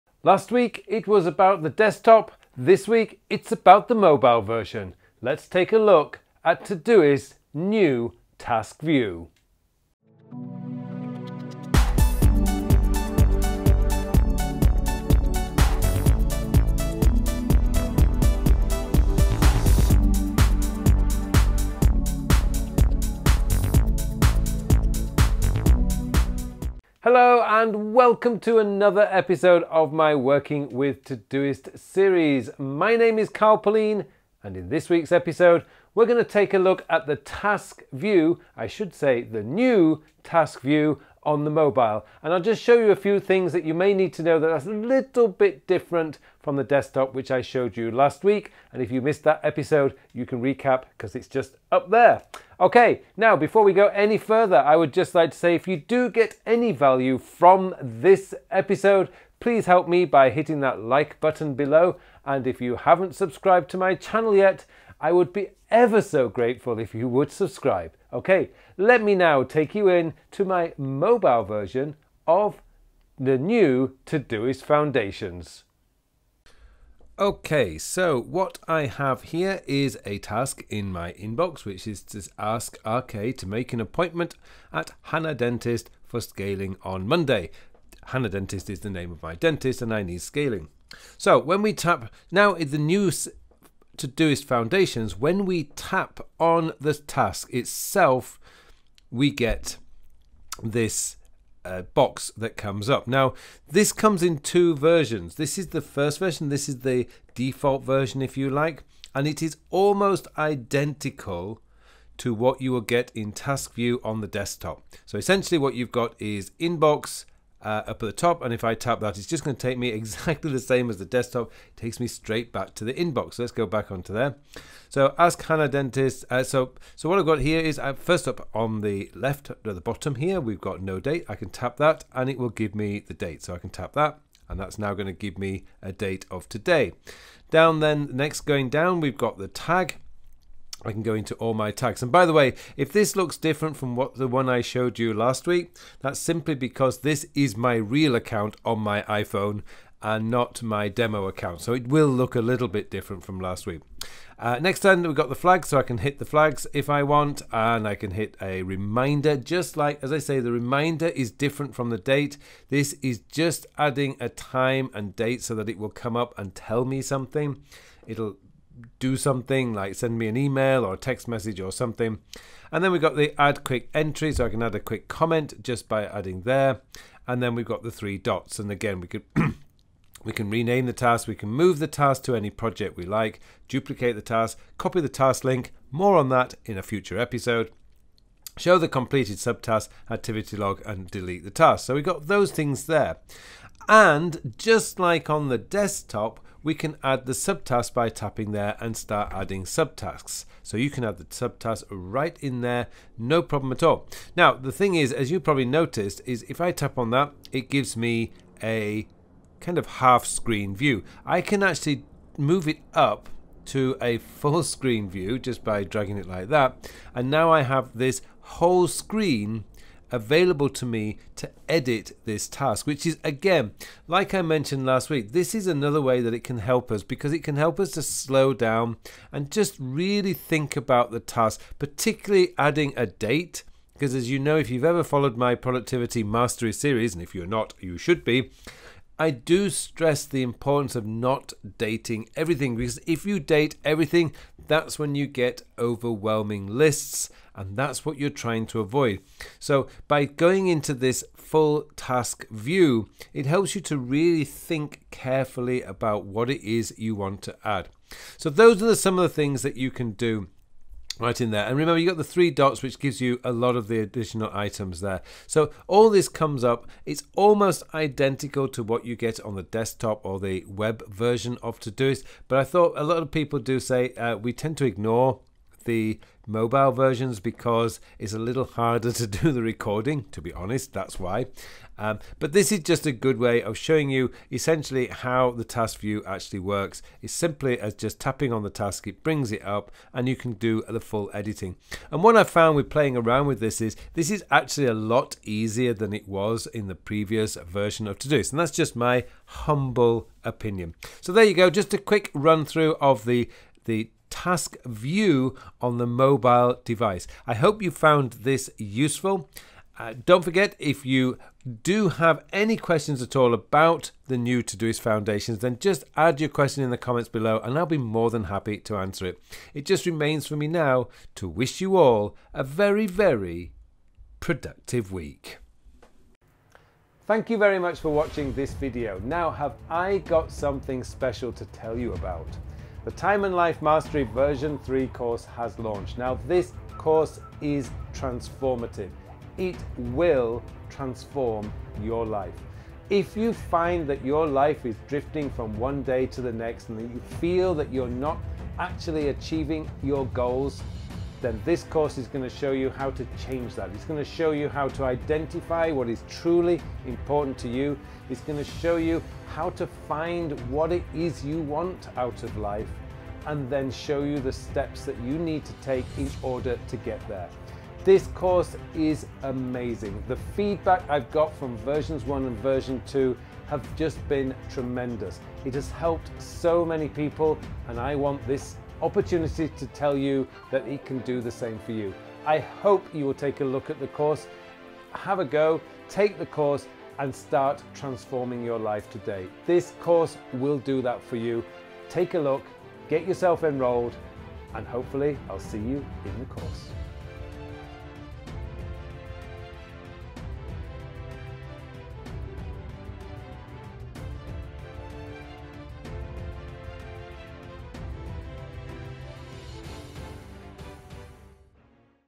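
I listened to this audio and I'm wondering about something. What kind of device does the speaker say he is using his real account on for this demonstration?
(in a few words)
iPhone.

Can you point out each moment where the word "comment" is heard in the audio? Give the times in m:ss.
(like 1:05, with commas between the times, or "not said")
2:55, 5:16.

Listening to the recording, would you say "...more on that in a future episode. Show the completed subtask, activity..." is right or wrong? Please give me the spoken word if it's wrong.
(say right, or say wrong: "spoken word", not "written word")
right.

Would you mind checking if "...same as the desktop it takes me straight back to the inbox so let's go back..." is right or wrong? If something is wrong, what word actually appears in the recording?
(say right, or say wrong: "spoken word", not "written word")
right.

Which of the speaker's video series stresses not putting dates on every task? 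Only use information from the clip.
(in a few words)
Productivity Mastery.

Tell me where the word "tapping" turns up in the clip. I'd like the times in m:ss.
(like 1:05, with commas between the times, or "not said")
3:18, 4:48.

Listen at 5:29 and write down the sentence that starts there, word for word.
Now have I got something special to tell you about.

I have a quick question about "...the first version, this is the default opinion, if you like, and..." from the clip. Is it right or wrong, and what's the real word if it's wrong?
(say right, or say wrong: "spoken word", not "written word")
wrong: "version", not "opinion".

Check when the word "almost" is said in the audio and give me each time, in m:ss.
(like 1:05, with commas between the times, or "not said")
1:49, 4:27.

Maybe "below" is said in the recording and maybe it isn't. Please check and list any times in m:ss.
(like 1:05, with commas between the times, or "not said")
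1:01, 5:17.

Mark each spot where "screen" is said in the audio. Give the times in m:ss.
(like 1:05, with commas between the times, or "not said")
3:30, 3:34, 3:38.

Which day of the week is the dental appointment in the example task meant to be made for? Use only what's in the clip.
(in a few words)
Monday.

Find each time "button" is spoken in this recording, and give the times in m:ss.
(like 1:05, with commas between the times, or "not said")
1:01.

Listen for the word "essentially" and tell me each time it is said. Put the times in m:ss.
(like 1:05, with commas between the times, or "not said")
1:55, 4:44.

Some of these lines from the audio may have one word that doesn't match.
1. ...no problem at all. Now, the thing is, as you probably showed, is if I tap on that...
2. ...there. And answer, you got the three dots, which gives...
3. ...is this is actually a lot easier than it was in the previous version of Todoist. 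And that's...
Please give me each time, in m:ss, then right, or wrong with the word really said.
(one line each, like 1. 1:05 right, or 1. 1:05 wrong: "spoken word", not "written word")
1. 3:23 wrong: "noticed", not "showed"
2. 4:21 wrong: "remember", not "answer"
3. 4:53 right.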